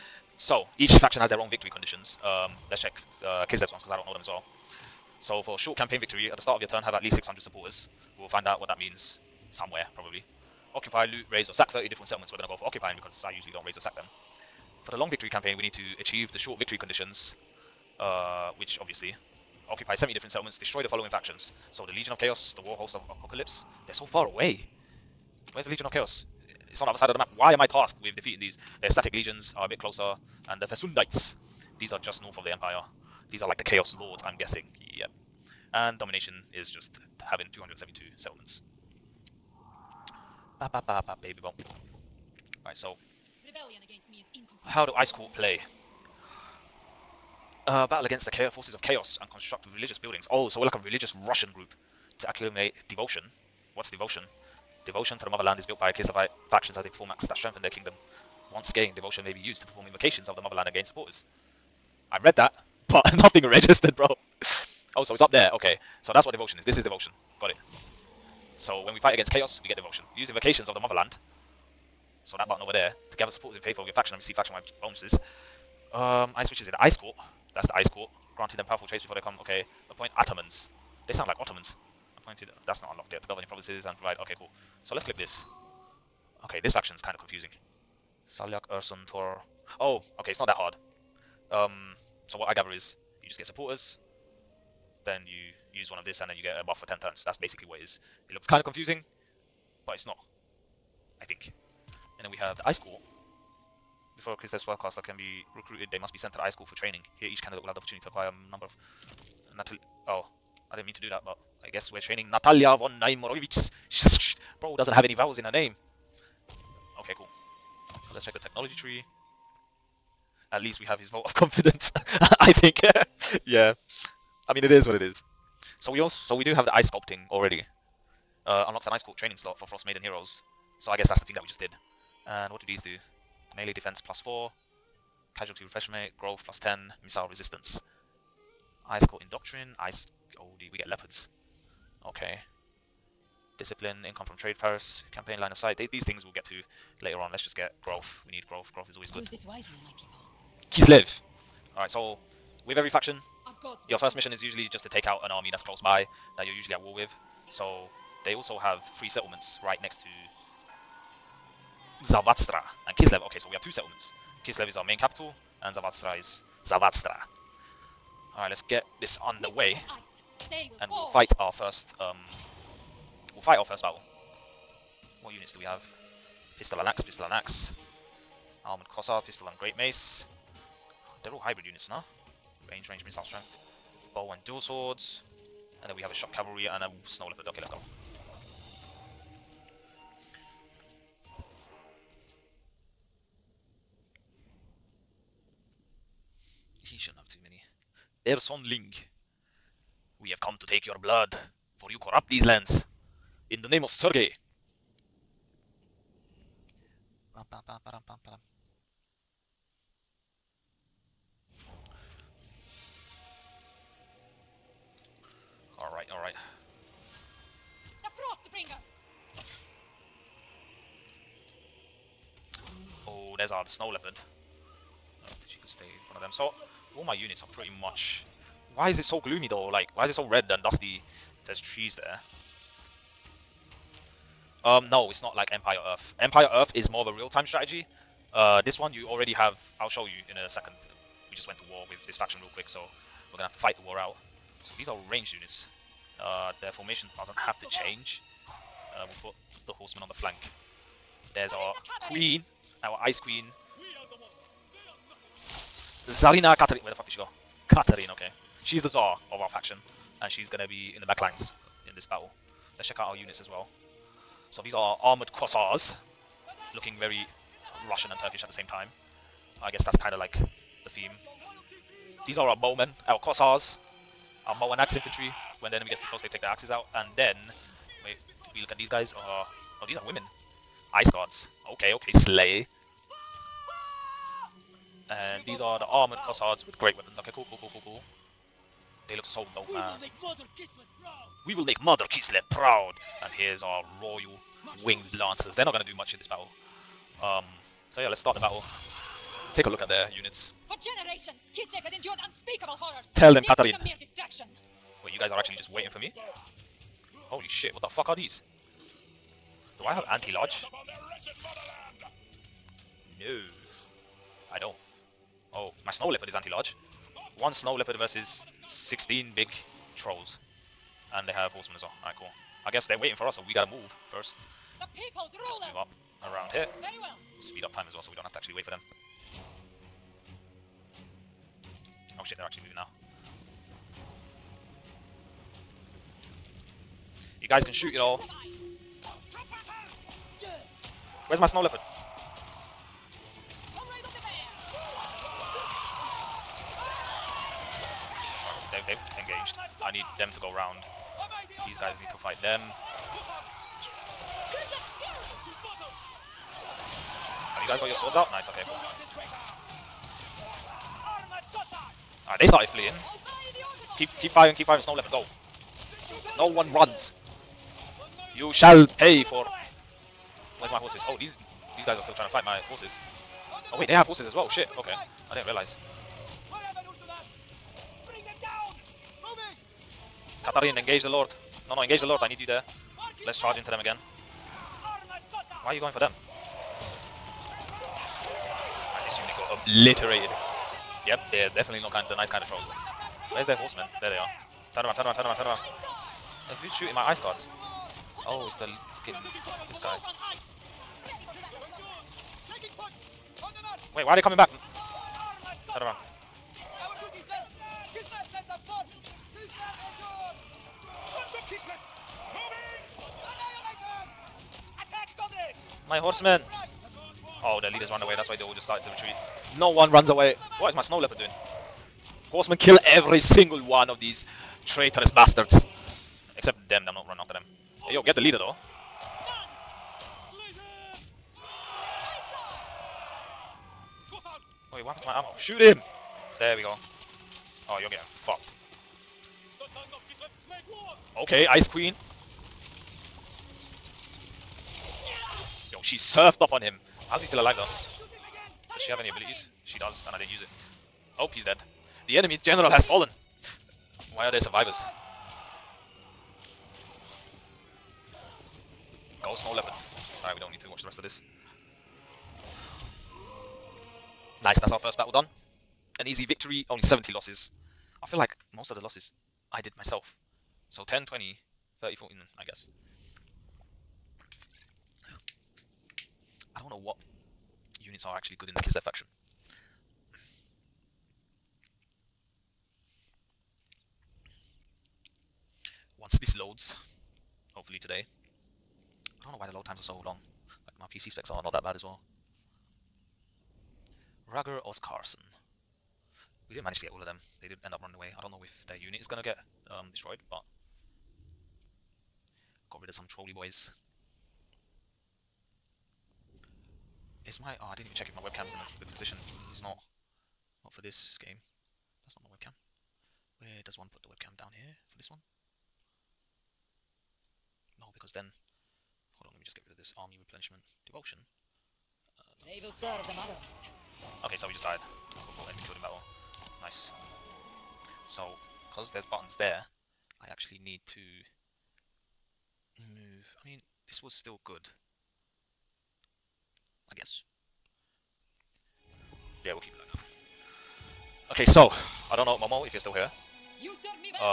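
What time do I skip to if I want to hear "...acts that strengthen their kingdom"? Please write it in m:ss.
0:57.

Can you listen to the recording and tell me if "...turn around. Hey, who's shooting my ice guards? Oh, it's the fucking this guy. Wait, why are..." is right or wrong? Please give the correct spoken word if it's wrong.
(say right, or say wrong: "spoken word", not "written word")
right.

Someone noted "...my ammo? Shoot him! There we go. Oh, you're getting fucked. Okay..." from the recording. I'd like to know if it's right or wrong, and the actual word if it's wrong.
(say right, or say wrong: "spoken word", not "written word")
right.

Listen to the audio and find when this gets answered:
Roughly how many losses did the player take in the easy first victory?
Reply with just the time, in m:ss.
7:46.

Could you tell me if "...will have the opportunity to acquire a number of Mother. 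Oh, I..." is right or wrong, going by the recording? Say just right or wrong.
wrong.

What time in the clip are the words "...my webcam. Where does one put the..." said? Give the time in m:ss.
8:32.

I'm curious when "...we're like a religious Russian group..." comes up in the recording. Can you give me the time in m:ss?
0:50.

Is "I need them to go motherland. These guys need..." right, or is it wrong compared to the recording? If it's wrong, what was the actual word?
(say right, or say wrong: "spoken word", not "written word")
wrong: "round", not "motherland".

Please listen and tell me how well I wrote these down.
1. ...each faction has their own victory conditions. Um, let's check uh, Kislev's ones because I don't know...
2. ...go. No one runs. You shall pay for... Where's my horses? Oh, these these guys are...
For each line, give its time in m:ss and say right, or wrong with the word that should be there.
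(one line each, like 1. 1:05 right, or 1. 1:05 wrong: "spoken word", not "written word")
1. 0:00 right
2. 6:05 right.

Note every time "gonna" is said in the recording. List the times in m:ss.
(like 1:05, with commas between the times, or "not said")
4:03, 4:20, 4:55, 8:19.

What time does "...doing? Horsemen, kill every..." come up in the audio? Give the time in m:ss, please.
7:01.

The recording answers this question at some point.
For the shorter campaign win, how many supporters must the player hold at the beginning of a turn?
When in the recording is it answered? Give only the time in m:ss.
0:07.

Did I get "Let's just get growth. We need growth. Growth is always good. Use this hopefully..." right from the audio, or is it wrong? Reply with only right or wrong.
wrong.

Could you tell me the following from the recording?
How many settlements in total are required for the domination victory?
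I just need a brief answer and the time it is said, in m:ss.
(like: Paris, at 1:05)
272, at 0:37.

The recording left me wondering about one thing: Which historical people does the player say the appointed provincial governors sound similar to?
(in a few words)
Ottomans.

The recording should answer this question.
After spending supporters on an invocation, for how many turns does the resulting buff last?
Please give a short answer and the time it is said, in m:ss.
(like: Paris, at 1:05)
10 turns, at 1:36.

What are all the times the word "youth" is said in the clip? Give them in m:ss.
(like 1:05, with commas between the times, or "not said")
not said.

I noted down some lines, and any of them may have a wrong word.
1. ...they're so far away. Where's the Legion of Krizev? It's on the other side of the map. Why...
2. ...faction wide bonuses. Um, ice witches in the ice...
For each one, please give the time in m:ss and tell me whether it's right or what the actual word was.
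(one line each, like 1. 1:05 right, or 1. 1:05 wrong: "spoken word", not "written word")
1. 0:23 wrong: "Chaos", not "Krizev"
2. 1:14 right.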